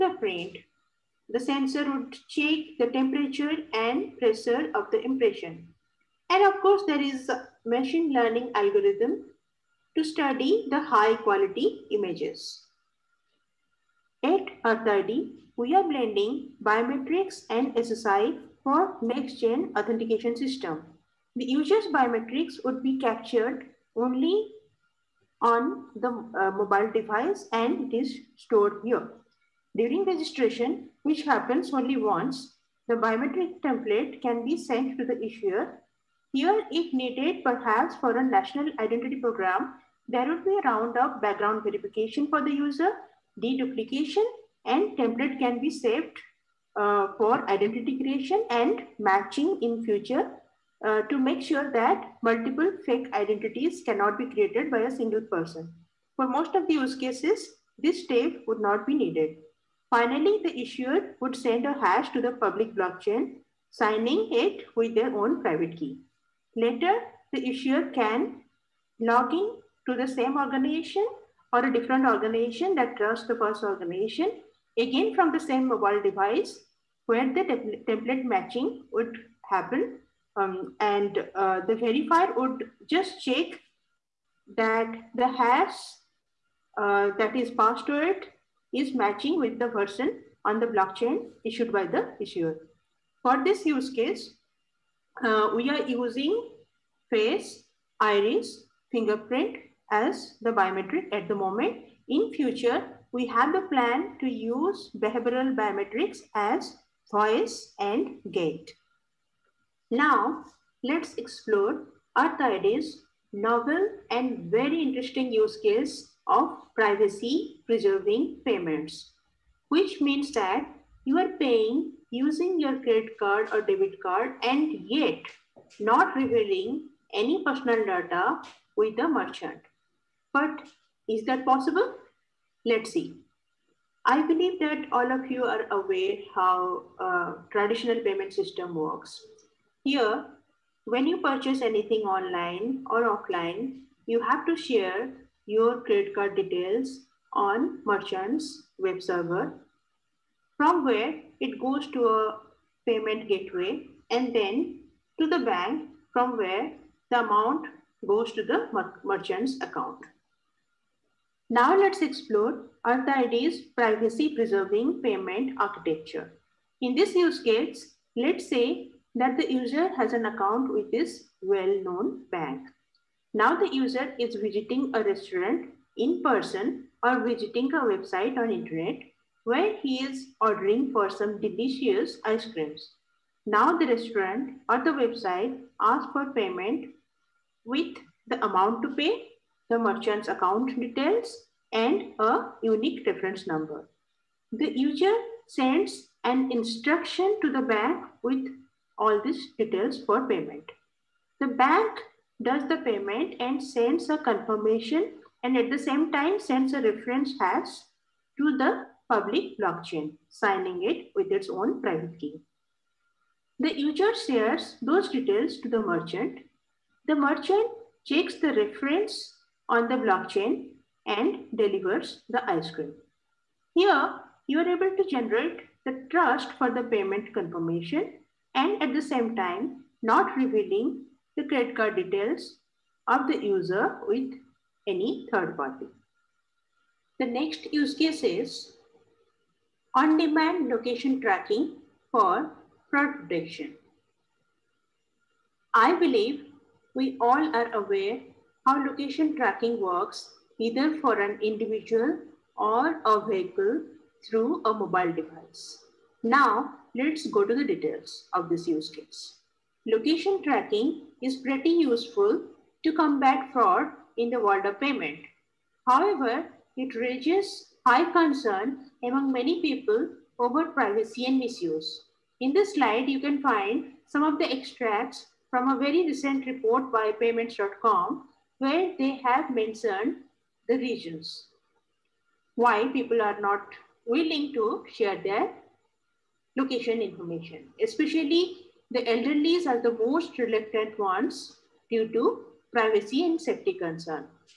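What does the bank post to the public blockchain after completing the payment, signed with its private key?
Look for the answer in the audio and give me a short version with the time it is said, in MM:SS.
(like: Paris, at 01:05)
reference hash, at 03:26.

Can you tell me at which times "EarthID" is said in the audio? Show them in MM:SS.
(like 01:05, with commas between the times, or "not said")
00:14, 01:52.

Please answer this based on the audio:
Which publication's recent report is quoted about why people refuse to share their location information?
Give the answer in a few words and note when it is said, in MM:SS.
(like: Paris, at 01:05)
PYMNTS.com, at 04:37.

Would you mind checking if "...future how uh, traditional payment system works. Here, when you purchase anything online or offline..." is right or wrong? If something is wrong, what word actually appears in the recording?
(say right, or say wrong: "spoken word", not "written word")
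wrong: "aware", not "future".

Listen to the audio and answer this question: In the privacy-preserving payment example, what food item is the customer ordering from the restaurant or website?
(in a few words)
ice creams.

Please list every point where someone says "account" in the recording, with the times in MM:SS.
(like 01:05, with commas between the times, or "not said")
02:39, 02:50, 03:10.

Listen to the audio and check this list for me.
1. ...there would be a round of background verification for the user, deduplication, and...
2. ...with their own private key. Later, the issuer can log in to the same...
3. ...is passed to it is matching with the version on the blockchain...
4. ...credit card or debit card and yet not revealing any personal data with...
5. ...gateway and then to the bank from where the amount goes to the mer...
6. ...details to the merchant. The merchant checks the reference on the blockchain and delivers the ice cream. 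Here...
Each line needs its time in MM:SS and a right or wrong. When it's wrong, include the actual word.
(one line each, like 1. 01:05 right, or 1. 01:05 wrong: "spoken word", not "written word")
1. 00:40 right
2. 01:04 right
3. 01:27 right
4. 02:02 right
5. 02:33 right
6. 03:35 right.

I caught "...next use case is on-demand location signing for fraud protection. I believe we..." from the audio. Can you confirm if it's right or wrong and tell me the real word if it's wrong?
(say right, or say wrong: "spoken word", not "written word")
wrong: "tracking", not "signing".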